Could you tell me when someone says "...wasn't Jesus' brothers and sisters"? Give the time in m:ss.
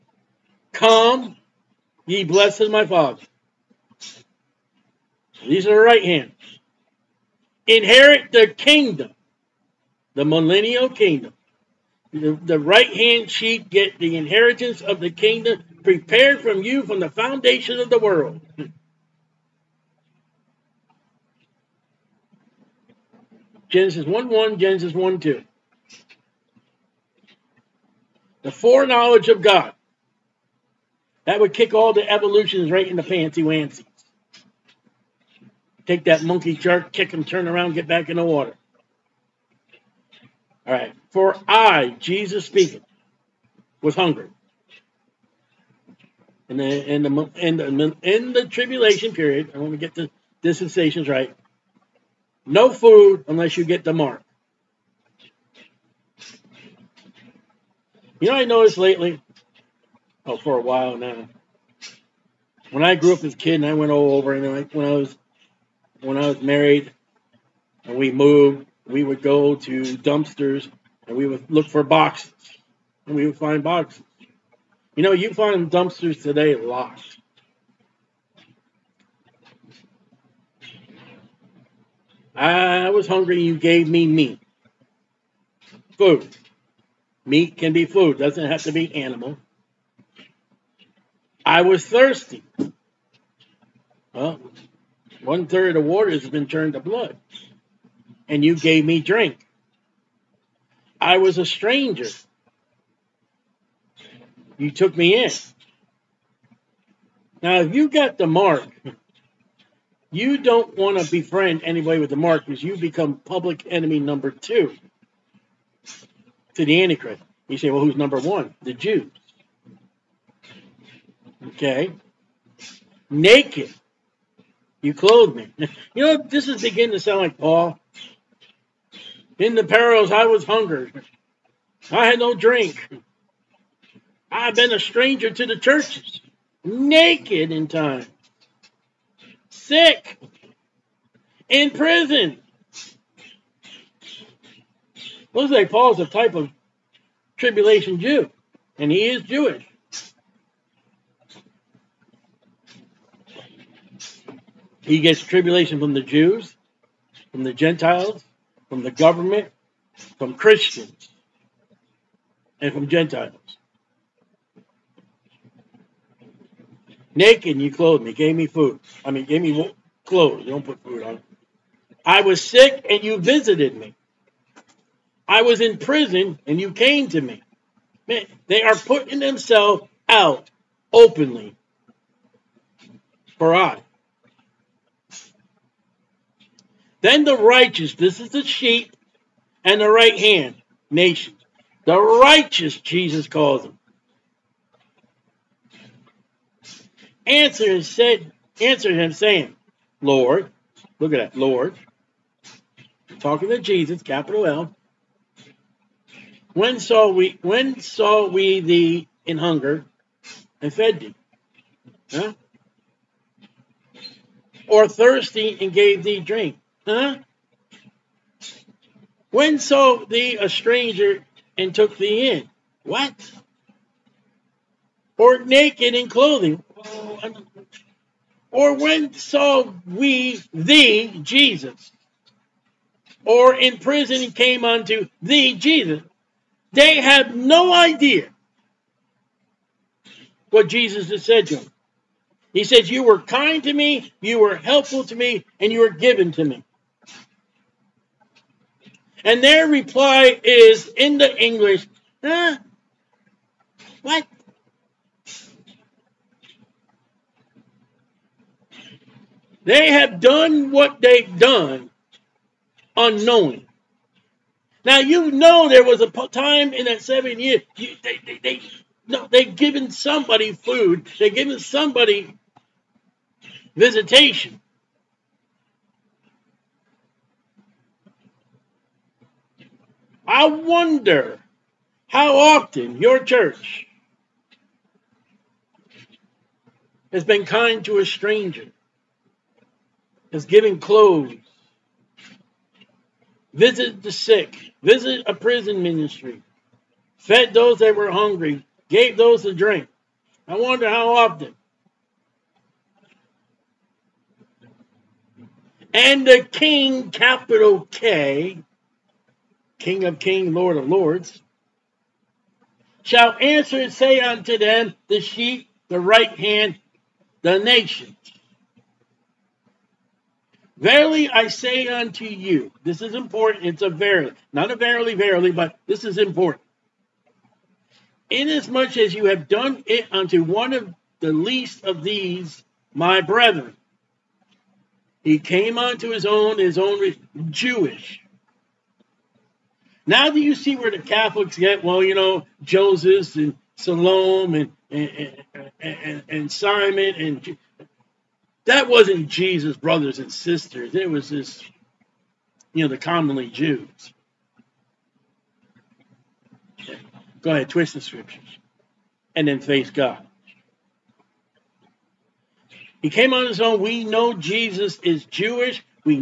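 5:48.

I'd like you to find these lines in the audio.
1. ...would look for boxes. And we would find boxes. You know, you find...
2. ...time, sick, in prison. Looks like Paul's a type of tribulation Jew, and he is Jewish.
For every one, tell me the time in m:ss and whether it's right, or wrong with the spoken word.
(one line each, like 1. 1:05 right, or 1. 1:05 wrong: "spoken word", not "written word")
1. 1:11 right
2. 2:17 right.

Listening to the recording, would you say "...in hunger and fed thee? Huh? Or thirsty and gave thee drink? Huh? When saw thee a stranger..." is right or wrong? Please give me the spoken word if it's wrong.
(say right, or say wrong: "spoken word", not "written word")
right.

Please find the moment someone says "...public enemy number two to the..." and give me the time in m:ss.
1:53.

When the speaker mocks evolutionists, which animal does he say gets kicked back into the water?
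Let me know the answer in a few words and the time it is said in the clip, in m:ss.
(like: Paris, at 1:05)
Monkey, at 0:36.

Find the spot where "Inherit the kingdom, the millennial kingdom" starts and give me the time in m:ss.
0:07.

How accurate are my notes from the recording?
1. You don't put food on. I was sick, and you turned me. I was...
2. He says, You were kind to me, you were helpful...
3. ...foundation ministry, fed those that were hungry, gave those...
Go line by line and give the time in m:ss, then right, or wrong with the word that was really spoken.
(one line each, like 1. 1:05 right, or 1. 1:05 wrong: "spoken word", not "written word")
1. 2:50 wrong: "visited", not "turned"
2. 4:02 right
3. 4:55 wrong: "prison", not "foundation".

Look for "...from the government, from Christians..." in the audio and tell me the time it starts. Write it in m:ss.
2:38.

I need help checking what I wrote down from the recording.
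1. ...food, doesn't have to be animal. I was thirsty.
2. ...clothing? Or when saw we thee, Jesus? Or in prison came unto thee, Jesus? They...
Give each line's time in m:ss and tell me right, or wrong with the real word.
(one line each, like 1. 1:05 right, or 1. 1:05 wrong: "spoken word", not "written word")
1. 1:27 right
2. 3:46 right.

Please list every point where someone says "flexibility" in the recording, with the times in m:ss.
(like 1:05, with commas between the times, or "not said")
not said.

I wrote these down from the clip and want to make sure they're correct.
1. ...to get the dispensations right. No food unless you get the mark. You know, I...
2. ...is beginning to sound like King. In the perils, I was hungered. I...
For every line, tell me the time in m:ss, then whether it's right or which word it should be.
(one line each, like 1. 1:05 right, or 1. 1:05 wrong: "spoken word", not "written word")
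1. 0:49 right
2. 2:06 wrong: "Paul", not "King".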